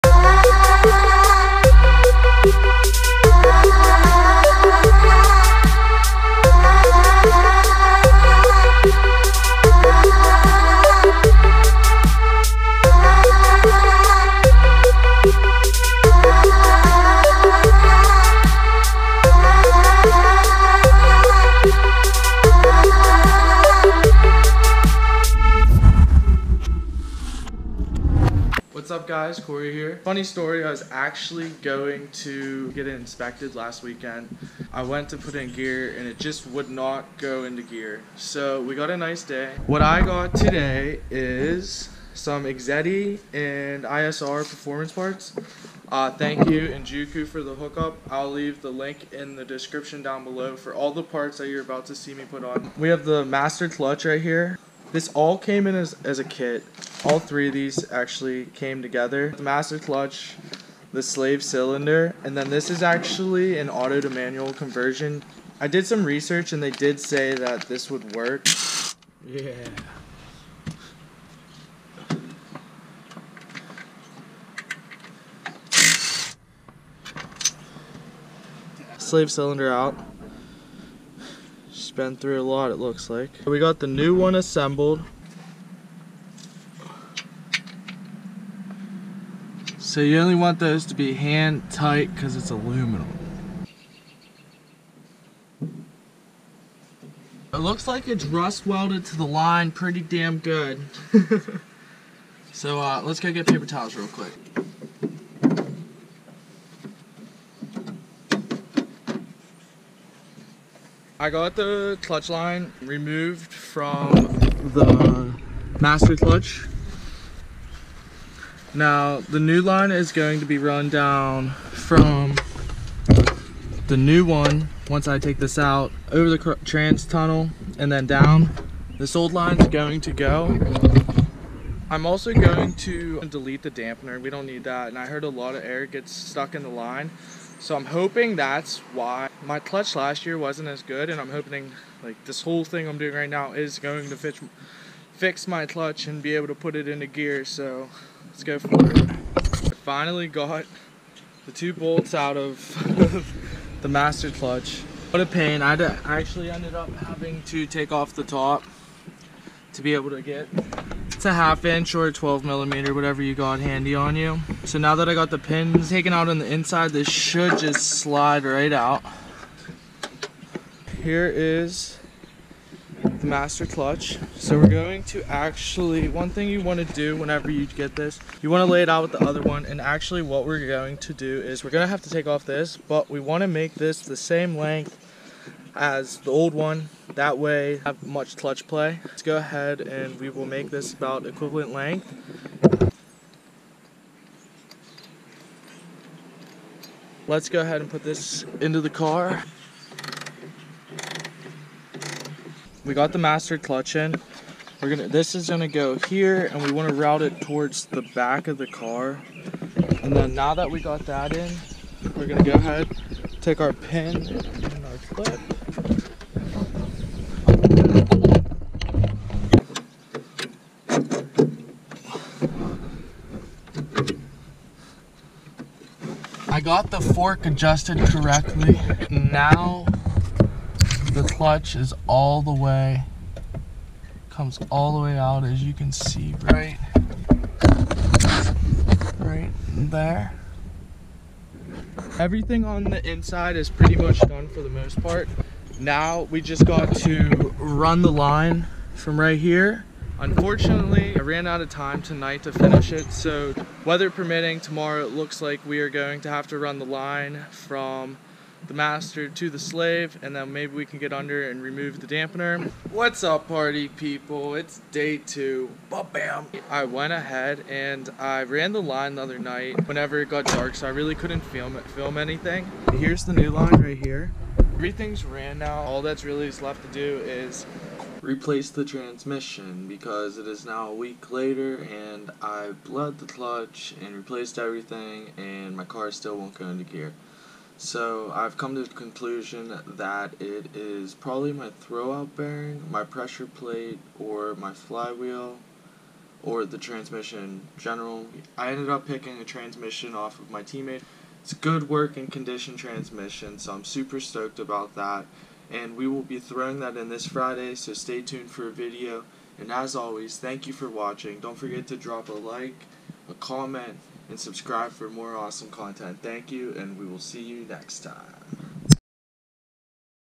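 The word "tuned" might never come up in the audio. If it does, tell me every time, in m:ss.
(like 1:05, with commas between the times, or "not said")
5:08.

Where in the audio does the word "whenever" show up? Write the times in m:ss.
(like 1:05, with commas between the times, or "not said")
2:57, 4:29.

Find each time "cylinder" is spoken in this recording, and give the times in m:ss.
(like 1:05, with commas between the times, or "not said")
1:01, 1:19.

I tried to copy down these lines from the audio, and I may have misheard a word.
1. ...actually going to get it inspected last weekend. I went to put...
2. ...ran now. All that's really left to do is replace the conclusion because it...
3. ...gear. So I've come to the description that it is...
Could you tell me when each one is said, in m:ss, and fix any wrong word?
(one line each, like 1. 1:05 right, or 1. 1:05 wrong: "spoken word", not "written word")
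1. 0:30 right
2. 4:35 wrong: "transmission", not "conclusion"
3. 4:46 wrong: "conclusion", not "description".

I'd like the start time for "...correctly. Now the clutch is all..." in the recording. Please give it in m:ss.
3:47.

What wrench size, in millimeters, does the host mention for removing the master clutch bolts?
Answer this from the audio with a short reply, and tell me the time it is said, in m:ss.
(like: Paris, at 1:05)
12 millimeter, at 2:42.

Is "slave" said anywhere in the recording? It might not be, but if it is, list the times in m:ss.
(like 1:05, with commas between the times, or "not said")
1:01, 1:18, 4:19.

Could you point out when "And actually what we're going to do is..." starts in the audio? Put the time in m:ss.
2:59.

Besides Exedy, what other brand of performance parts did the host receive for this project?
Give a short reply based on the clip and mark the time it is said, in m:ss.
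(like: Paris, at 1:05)
ISR, at 0:43.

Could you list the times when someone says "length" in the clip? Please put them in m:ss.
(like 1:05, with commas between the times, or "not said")
3:04, 3:11.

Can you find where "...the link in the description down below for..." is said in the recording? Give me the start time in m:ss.
0:48.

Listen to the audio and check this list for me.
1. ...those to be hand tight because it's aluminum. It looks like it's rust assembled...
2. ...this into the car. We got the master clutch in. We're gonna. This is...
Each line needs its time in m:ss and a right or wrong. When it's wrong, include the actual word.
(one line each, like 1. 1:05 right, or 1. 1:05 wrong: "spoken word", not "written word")
1. 1:30 wrong: "welded", not "assembled"
2. 3:18 right.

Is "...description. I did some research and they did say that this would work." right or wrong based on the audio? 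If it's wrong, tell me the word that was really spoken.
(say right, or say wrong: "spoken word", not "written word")
wrong: "conversion", not "description".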